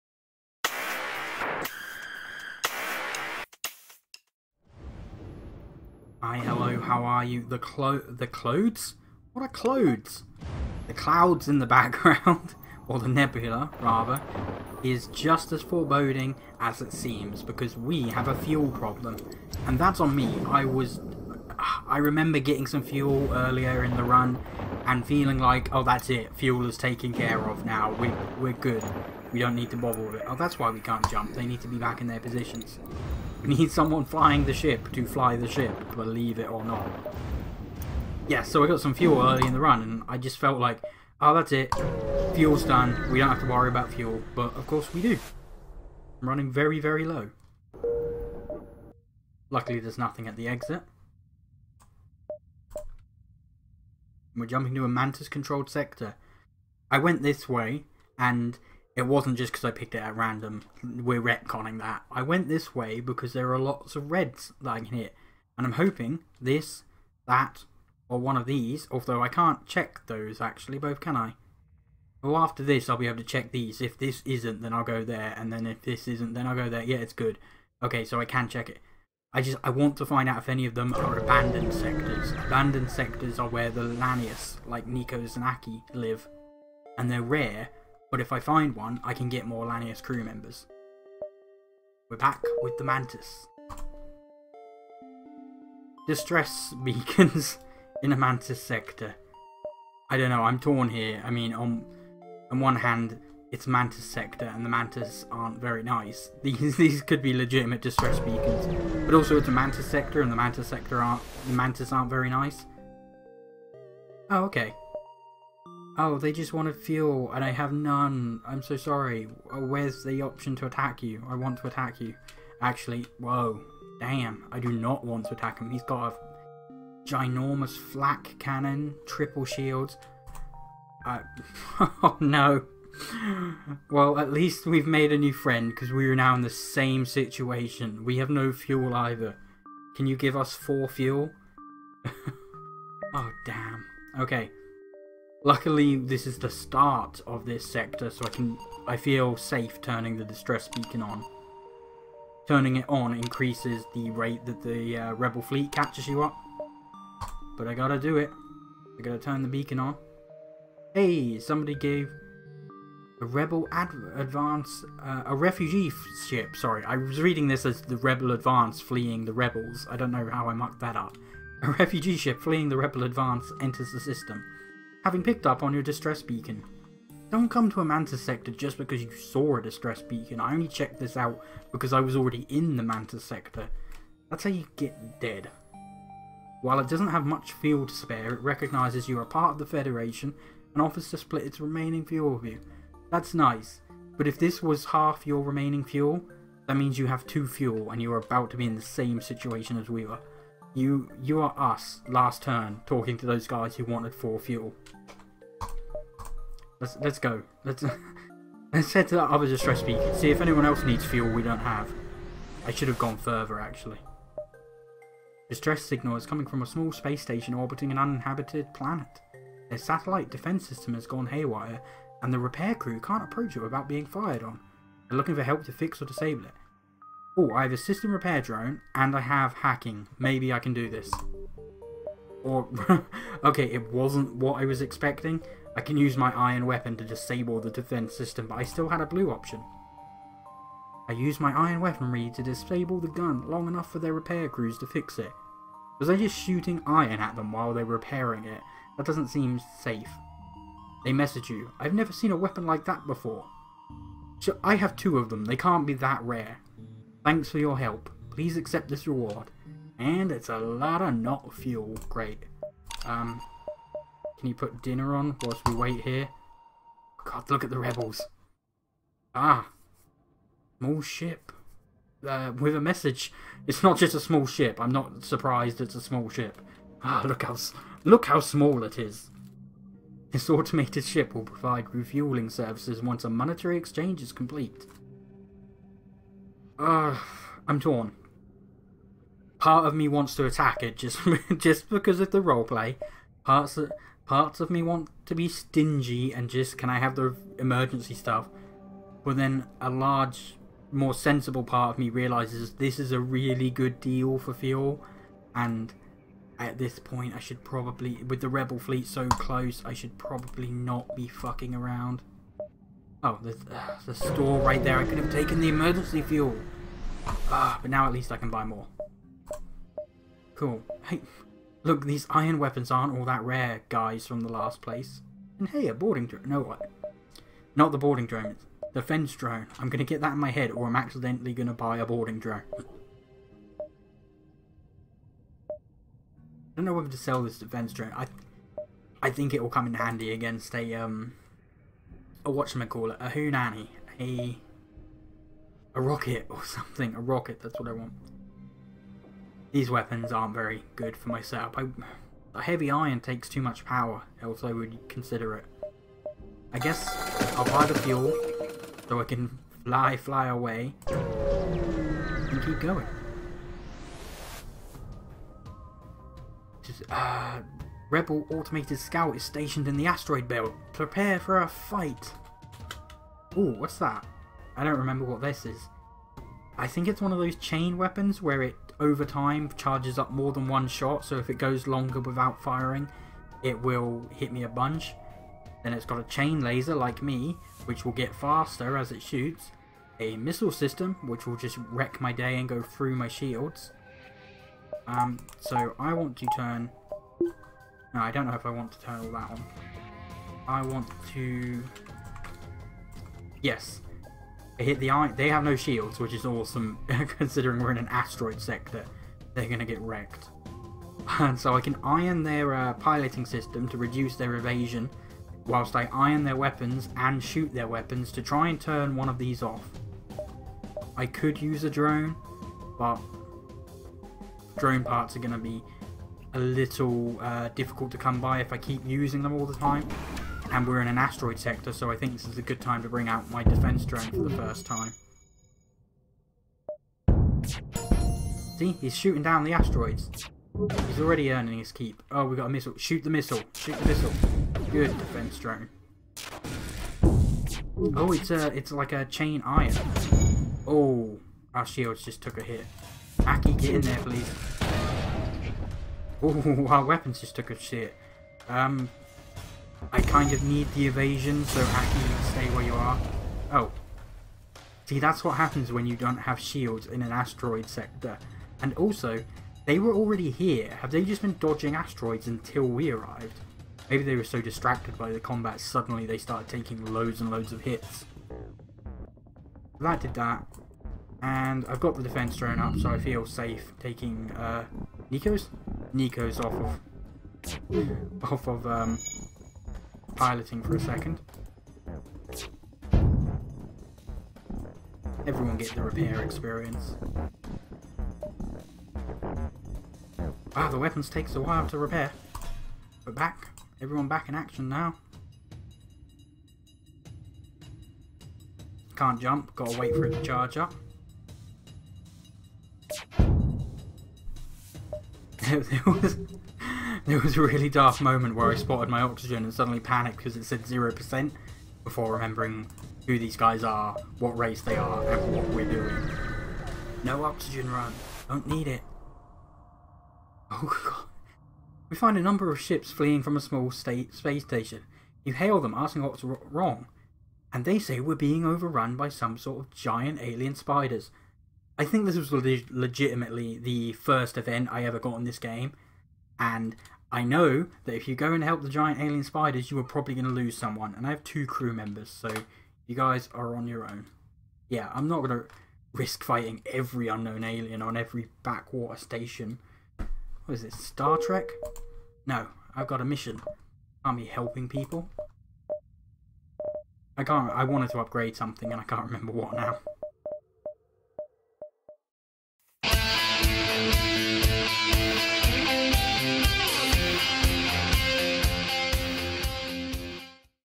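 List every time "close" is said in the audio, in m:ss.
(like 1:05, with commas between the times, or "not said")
5:09.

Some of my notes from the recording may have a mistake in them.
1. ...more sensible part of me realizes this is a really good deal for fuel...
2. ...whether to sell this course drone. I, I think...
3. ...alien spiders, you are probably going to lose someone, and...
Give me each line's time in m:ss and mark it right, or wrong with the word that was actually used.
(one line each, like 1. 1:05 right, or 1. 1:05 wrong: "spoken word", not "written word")
1. 5:00 right
2. 5:36 wrong: "defense", not "course"
3. 9:09 right.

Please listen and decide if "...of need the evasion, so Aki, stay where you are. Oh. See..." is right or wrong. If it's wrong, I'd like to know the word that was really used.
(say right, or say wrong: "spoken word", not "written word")
right.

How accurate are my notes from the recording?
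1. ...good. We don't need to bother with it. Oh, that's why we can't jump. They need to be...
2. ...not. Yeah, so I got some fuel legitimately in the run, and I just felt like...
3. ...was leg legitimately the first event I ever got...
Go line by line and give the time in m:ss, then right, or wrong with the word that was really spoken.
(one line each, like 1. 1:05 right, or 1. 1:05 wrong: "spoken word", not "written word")
1. 0:28 right
2. 0:36 wrong: "early", not "legitimately"
3. 9:02 right.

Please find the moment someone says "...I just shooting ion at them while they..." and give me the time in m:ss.
4:06.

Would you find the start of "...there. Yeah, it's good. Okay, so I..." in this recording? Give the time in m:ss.
1:16.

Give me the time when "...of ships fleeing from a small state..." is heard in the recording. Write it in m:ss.
8:52.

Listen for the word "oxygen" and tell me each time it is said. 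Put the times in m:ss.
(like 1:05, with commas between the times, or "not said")
8:39, 8:47.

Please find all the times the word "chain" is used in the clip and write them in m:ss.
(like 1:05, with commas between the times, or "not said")
6:17, 6:26, 7:29.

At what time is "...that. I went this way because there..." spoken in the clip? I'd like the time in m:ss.
1:01.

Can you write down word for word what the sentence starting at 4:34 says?
I'm not surprised it's a small ship.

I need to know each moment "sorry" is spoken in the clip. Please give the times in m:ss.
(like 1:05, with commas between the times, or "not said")
1:58, 2:46.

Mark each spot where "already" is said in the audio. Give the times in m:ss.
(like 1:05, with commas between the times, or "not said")
3:02, 7:21, 7:50.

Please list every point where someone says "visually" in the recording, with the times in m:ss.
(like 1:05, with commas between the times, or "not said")
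not said.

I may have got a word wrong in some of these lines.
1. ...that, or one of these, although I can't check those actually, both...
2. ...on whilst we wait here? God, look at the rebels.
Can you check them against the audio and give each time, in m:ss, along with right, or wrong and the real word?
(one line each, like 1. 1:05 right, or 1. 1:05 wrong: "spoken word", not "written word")
1. 1:07 right
2. 4:25 right.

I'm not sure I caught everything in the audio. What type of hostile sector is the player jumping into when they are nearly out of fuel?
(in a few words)
Mantis-controlled.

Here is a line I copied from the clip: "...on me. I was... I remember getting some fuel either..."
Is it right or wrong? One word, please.
wrong.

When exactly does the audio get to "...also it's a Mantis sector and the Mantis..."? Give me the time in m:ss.
1:49.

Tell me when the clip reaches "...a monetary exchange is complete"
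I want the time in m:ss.
4:43.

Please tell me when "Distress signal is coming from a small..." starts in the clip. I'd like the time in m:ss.
3:35.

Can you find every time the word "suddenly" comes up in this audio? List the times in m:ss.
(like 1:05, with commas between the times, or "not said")
7:55, 8:39.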